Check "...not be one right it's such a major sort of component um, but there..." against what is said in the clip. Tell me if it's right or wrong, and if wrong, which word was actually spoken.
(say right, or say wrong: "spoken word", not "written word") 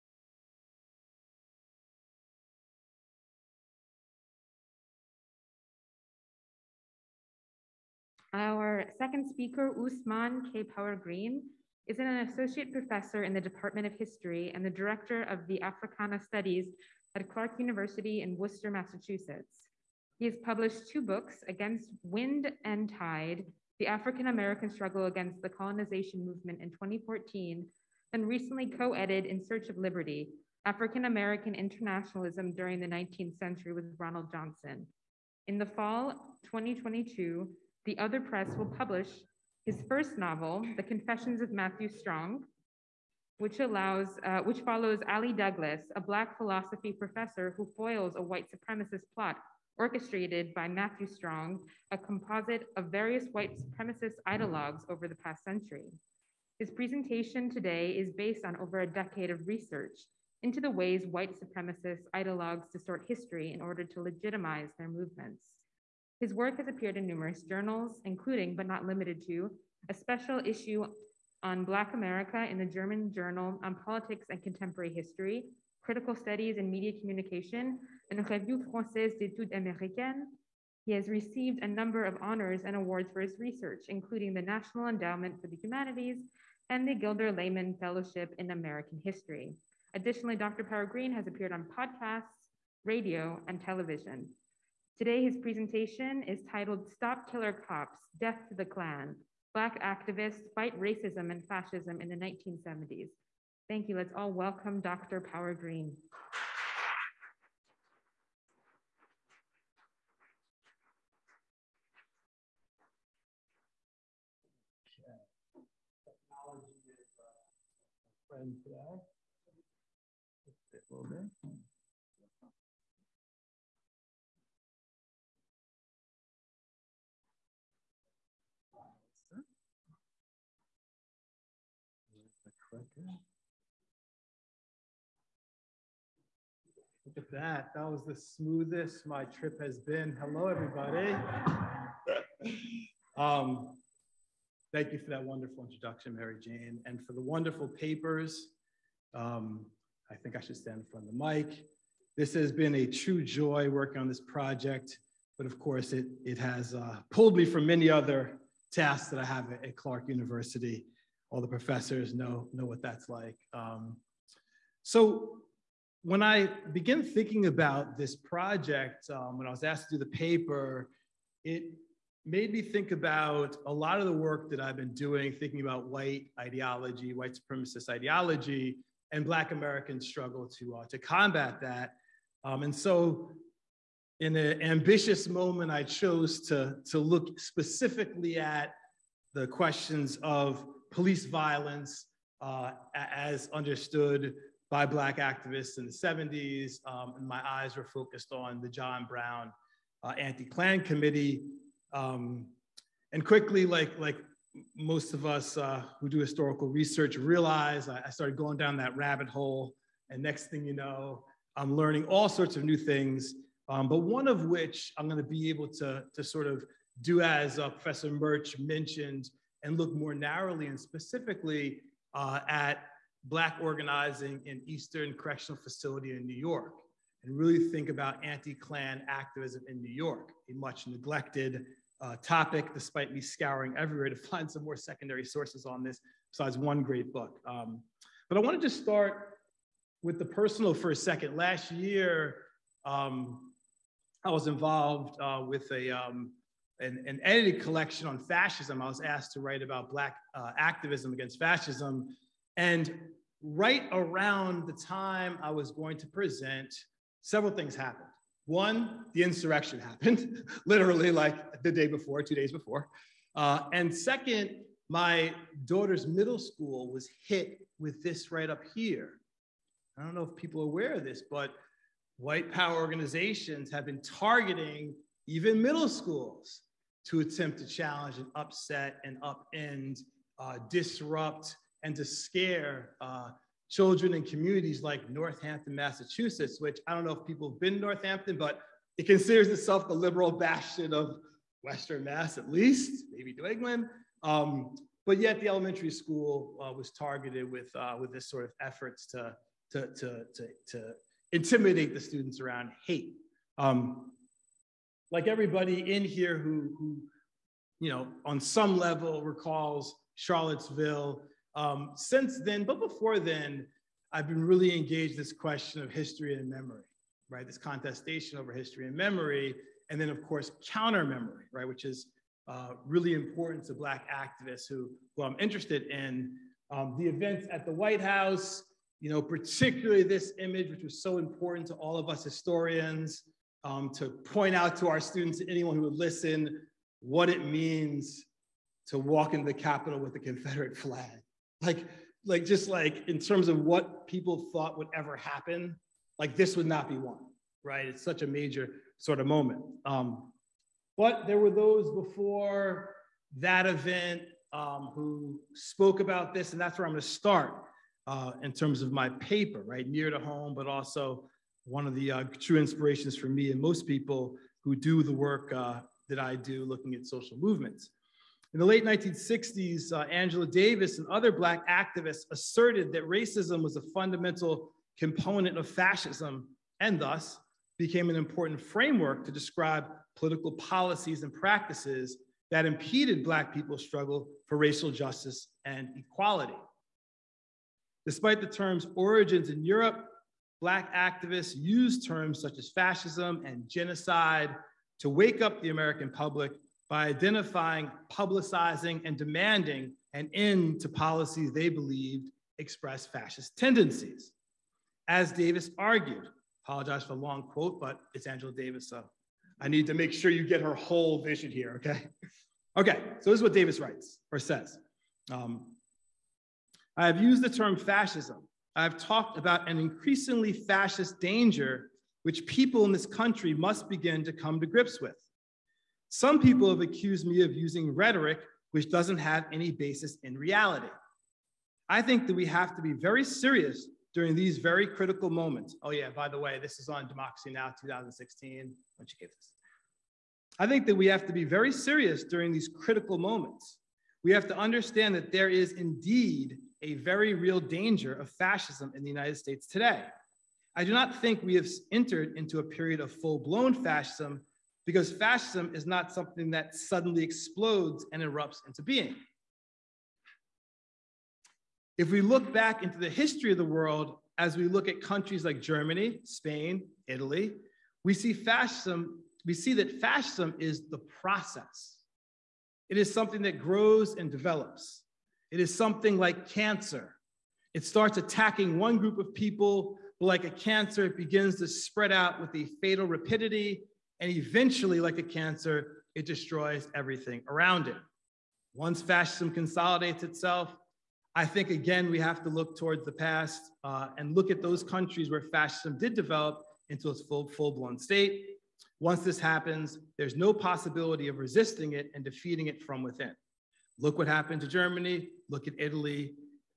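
wrong: "moment", not "component".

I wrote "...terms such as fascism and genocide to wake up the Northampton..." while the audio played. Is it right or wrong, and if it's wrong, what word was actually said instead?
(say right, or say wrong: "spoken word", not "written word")
wrong: "American", not "Northampton".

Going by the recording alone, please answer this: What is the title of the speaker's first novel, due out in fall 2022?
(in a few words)
The Confessions of Matthew Strong.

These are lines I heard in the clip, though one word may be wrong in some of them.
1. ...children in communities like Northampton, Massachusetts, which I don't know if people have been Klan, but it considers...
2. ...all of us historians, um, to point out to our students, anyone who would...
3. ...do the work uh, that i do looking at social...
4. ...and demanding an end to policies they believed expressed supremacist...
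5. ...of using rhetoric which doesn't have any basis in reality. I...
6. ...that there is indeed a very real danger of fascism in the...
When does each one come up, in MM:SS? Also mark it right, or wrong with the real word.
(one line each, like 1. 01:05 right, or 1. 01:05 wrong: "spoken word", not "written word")
1. 04:43 wrong: "Northampton", not "Klan"
2. 05:31 right
3. 06:04 right
4. 06:39 wrong: "fascist", not "supremacist"
5. 07:07 right
6. 07:25 right.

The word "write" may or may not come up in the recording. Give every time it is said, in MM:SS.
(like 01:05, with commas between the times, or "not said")
04:09, 06:53.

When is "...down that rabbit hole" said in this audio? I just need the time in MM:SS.
03:28.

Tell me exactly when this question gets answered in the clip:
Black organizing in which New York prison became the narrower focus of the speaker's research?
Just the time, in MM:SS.
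03:44.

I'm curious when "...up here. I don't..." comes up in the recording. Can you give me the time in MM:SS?
04:28.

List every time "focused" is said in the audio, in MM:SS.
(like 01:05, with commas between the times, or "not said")
03:17.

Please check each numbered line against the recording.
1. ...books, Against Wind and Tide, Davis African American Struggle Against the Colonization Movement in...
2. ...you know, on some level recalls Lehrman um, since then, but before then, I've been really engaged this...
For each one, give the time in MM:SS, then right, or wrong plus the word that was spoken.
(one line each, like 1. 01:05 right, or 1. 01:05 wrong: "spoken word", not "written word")
1. 00:20 wrong: "The", not "Davis"
2. 05:07 wrong: "Charlottesville", not "Lehrman".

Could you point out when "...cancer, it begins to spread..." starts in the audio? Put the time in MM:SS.
08:00.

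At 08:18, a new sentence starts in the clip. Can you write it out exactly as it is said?
Once this happens, there's no possibility of resisting it and defeating it from within.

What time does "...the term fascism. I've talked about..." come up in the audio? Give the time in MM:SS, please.
06:57.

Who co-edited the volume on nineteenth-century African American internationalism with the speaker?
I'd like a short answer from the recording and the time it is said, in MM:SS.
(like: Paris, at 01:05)
Ronald Johnson, at 00:33.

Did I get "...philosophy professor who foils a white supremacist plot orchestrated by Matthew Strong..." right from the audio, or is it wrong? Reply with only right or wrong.
right.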